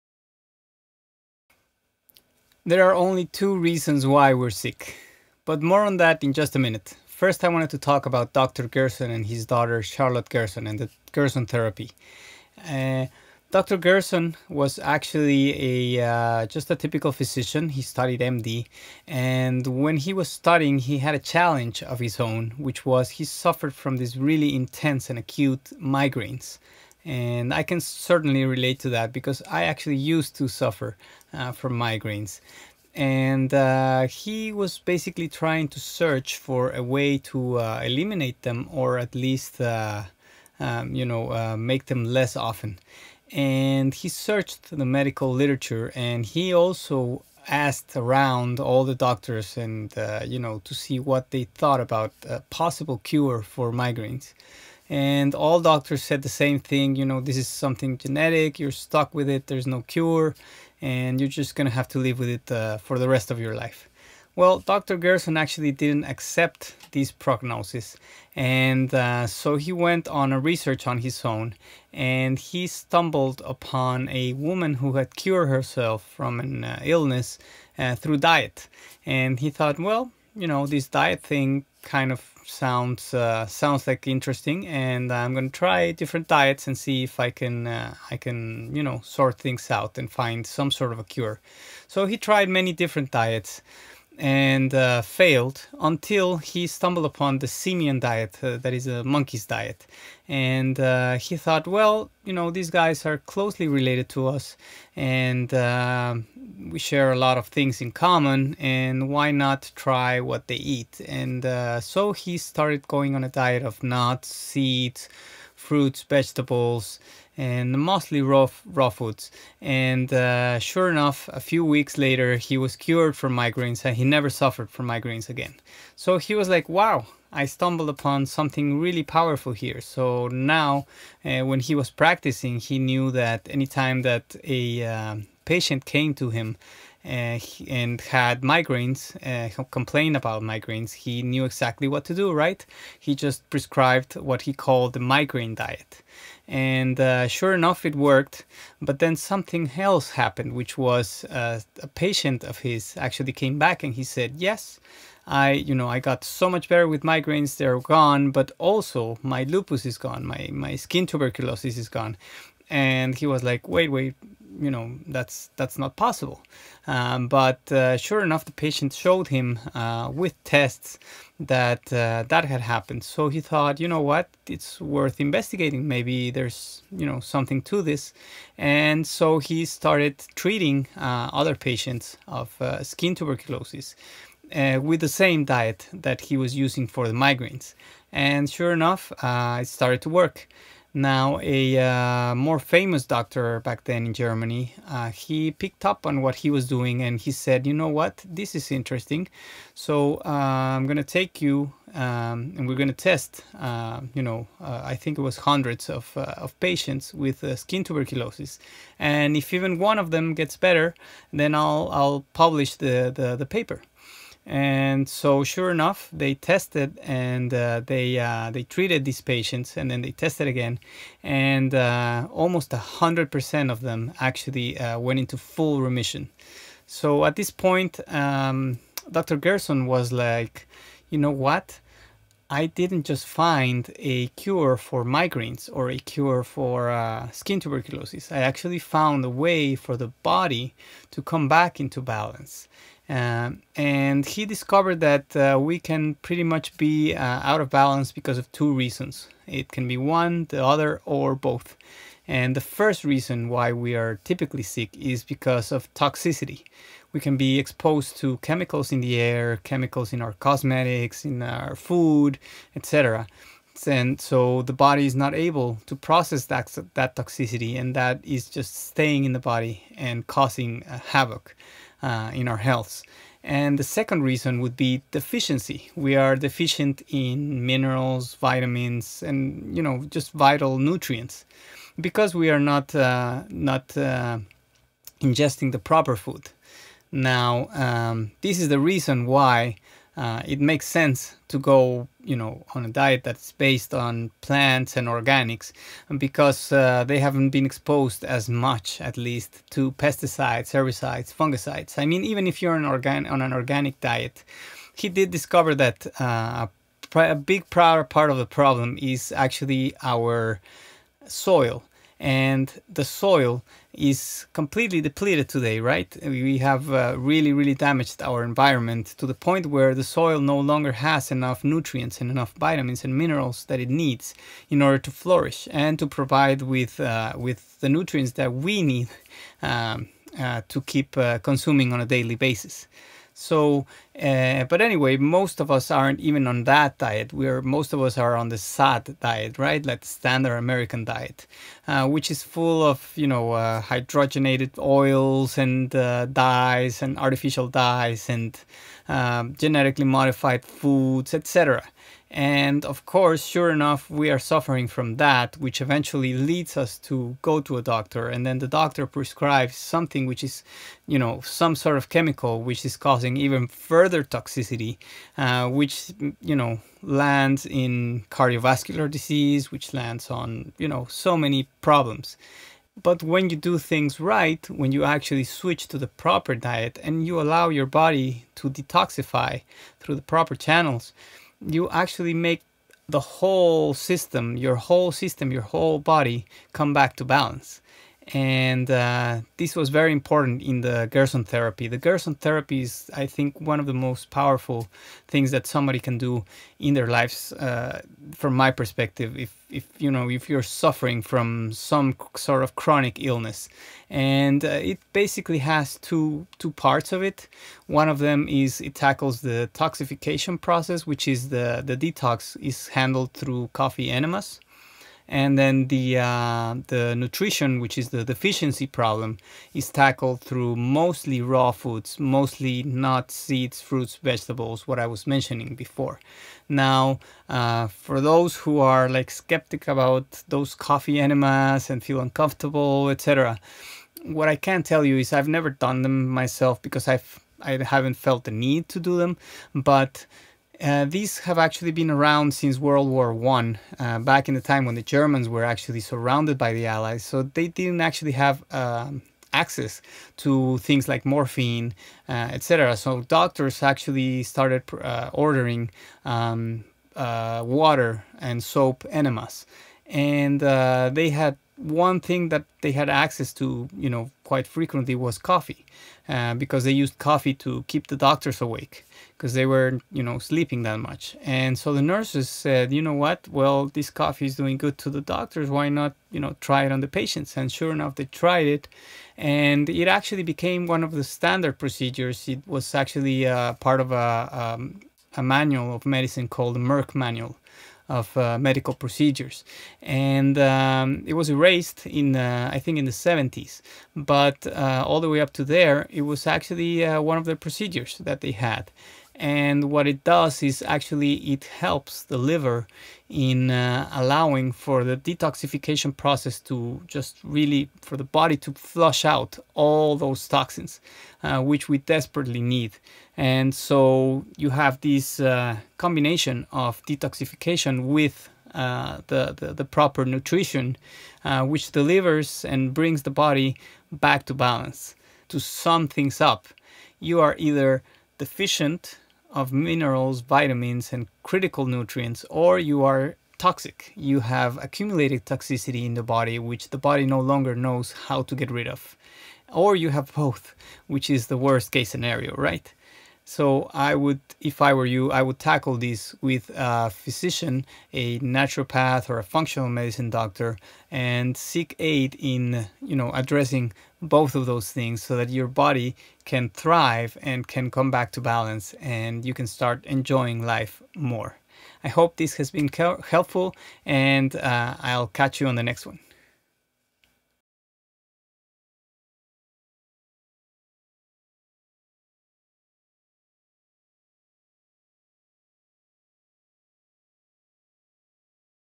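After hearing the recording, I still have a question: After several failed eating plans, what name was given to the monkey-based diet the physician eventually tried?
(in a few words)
Simian diet.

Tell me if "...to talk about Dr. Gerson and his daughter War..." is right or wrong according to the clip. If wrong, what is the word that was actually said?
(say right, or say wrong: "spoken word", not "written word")
wrong: "Charlotte", not "War".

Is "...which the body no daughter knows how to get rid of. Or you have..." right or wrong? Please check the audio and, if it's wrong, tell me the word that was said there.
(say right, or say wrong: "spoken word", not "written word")
wrong: "longer", not "daughter".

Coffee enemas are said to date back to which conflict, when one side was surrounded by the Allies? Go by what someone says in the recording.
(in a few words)
World War One.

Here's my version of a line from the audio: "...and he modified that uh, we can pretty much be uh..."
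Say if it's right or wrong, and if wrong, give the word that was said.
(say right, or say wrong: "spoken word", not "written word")
wrong: "discovered", not "modified".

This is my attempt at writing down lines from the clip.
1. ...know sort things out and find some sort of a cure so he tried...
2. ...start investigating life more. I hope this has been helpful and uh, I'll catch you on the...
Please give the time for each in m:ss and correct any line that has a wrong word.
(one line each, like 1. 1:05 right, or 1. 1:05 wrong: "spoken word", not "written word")
1. 1:28 right
2. 9:19 wrong: "enjoying", not "investigating".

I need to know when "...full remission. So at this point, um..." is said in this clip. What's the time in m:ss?
3:45.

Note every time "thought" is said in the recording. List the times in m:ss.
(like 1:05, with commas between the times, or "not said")
0:51, 1:19, 1:41, 2:53.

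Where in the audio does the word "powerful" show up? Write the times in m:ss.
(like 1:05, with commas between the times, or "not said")
2:09, 6:34.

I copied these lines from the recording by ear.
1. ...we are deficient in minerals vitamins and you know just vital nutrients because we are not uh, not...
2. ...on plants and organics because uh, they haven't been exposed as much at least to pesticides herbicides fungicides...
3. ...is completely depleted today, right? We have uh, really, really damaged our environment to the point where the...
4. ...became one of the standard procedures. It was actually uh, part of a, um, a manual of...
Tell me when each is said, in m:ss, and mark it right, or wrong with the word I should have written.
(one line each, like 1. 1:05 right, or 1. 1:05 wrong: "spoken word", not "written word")
1. 4:35 right
2. 4:53 right
3. 5:13 right
4. 8:00 right.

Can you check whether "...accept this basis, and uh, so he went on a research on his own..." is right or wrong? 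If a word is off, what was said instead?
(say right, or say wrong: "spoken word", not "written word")
wrong: "prognosis", not "basis".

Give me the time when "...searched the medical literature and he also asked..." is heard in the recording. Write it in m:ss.
0:44.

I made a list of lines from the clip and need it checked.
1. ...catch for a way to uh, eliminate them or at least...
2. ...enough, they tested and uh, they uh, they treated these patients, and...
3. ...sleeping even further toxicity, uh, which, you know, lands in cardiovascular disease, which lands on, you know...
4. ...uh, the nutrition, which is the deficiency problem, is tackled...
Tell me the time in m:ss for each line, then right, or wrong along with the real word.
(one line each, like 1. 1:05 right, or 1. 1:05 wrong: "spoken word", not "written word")
1. 0:35 wrong: "search", not "catch"
2. 3:35 right
3. 6:02 wrong: "causing", not "sleeping"
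4. 6:56 right.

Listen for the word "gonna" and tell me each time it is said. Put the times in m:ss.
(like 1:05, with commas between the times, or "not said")
1:01, 1:25.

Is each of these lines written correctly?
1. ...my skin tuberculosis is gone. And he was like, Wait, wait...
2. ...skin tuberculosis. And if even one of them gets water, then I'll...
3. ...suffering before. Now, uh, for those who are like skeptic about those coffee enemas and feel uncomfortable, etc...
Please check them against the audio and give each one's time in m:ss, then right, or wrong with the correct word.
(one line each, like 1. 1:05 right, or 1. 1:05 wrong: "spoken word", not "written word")
1. 2:40 right
2. 3:27 wrong: "better", not "water"
3. 7:05 wrong: "mentioning", not "suffering".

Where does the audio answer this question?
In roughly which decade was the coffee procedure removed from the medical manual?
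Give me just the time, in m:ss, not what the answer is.
8:13.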